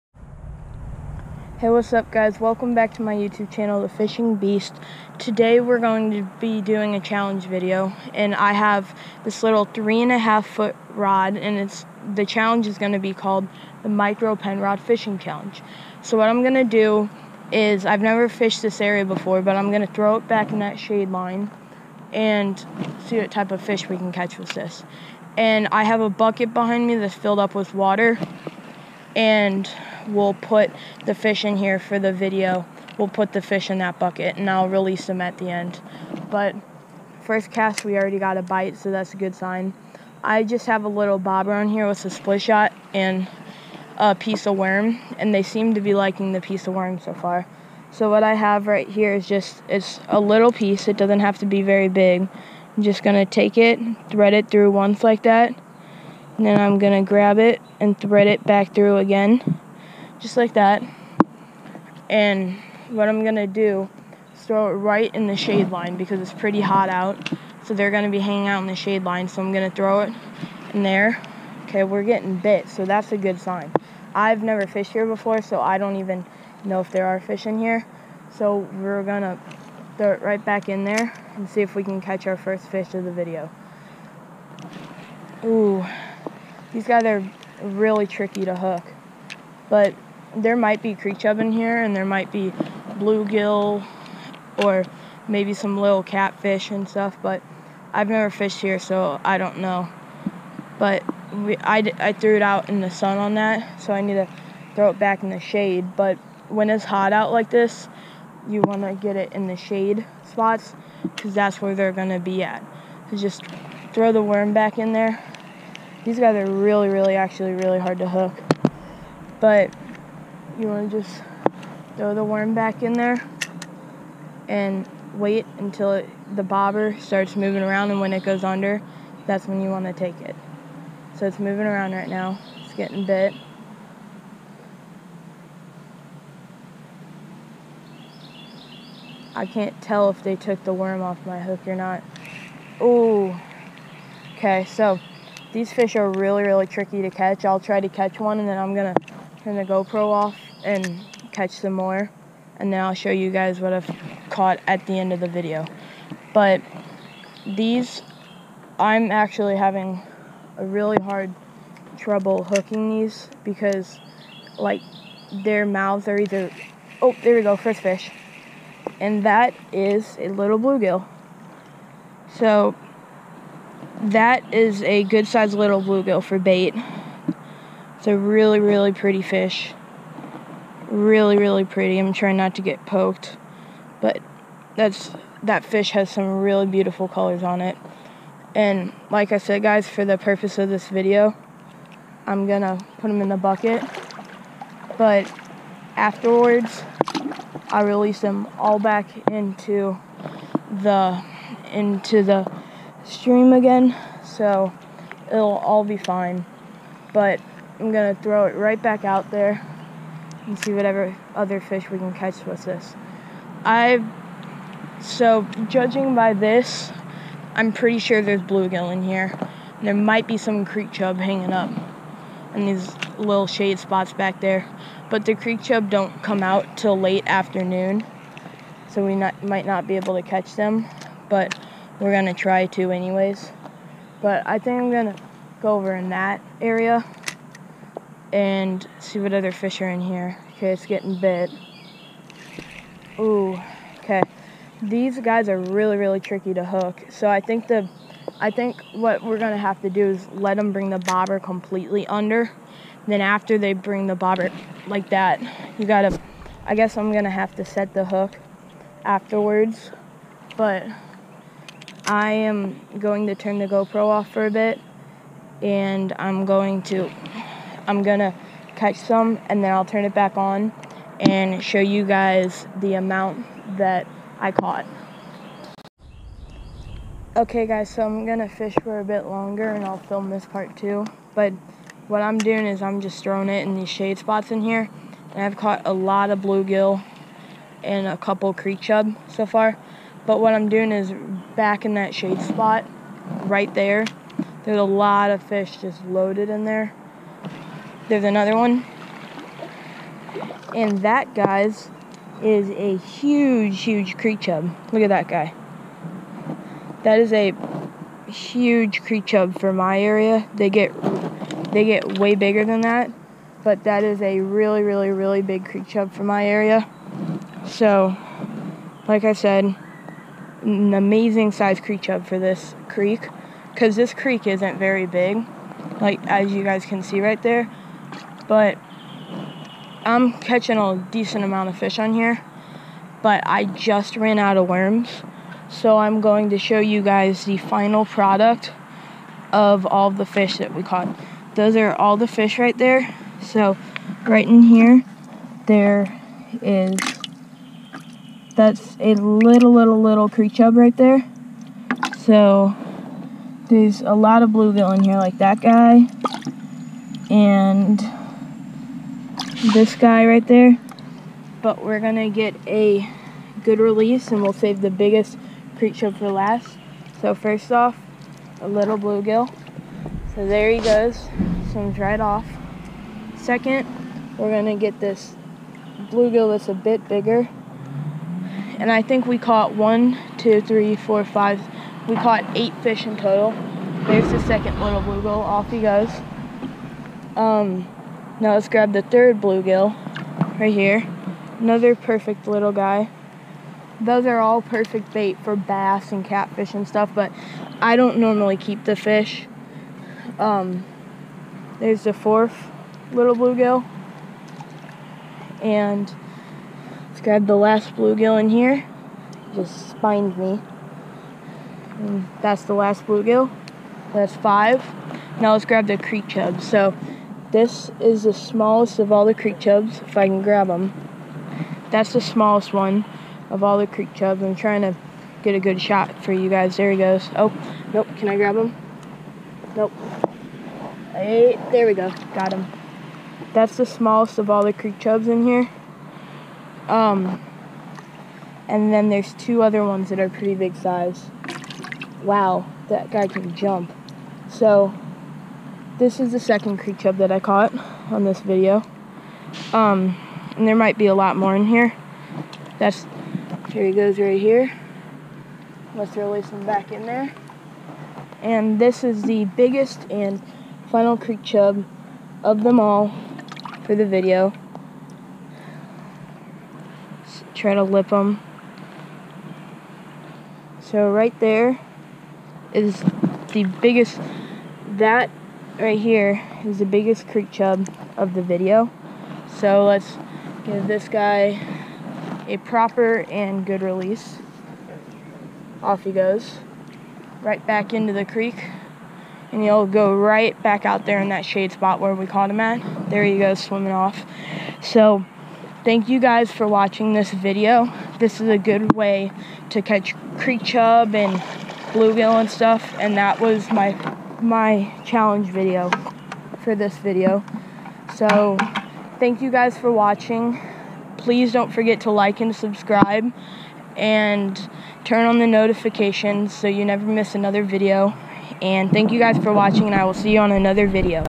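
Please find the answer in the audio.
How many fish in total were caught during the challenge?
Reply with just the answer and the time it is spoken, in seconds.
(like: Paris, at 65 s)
8, at 382 s.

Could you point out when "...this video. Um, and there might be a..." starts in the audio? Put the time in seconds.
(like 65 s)
448 s.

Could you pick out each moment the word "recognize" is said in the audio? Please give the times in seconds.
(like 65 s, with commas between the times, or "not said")
not said.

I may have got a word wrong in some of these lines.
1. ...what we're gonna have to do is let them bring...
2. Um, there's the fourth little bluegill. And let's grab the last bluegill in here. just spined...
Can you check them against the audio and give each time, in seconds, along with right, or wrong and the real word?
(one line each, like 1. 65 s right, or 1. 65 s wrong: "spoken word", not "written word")
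1. 248 s right
2. 400 s right.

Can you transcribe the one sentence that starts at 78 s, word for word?
So we're gonna throw it right back in there and see if we can catch our first fish of the video.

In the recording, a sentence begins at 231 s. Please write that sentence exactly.
But we're gonna try to anyways.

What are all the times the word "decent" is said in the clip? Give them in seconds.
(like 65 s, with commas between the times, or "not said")
331 s.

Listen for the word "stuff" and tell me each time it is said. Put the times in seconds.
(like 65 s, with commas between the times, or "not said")
96 s, 396 s, 502 s.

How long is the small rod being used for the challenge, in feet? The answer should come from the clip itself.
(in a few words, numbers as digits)
3.5 feet.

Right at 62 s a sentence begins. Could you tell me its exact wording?
And what I'm gonna do is throw it right in the shade line because it's pretty hot out.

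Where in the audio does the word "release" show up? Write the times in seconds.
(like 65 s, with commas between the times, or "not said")
34 s, 197 s, 363 s, 456 s, 483 s.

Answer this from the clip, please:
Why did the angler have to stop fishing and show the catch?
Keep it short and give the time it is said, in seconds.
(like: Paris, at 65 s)
ran out of worms, at 334 s.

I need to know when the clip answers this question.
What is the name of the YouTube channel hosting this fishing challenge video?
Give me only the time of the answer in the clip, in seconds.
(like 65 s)
3 s.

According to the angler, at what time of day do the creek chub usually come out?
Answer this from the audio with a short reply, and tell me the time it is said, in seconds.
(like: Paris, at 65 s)
late afternoon, at 226 s.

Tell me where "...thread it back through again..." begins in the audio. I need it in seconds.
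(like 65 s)
57 s.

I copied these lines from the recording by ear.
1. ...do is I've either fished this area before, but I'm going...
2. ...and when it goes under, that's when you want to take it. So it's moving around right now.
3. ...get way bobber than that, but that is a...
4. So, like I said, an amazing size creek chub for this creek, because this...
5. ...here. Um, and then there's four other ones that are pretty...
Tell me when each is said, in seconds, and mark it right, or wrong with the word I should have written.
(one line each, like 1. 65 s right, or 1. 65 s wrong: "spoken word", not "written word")
1. 16 s wrong: "never", not "either"
2. 127 s right
3. 311 s wrong: "bigger", not "bobber"
4. 317 s right
5. 435 s wrong: "two", not "four".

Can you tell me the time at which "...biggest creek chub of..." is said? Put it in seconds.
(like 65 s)
476 s.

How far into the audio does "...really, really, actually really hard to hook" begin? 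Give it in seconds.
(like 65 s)
116 s.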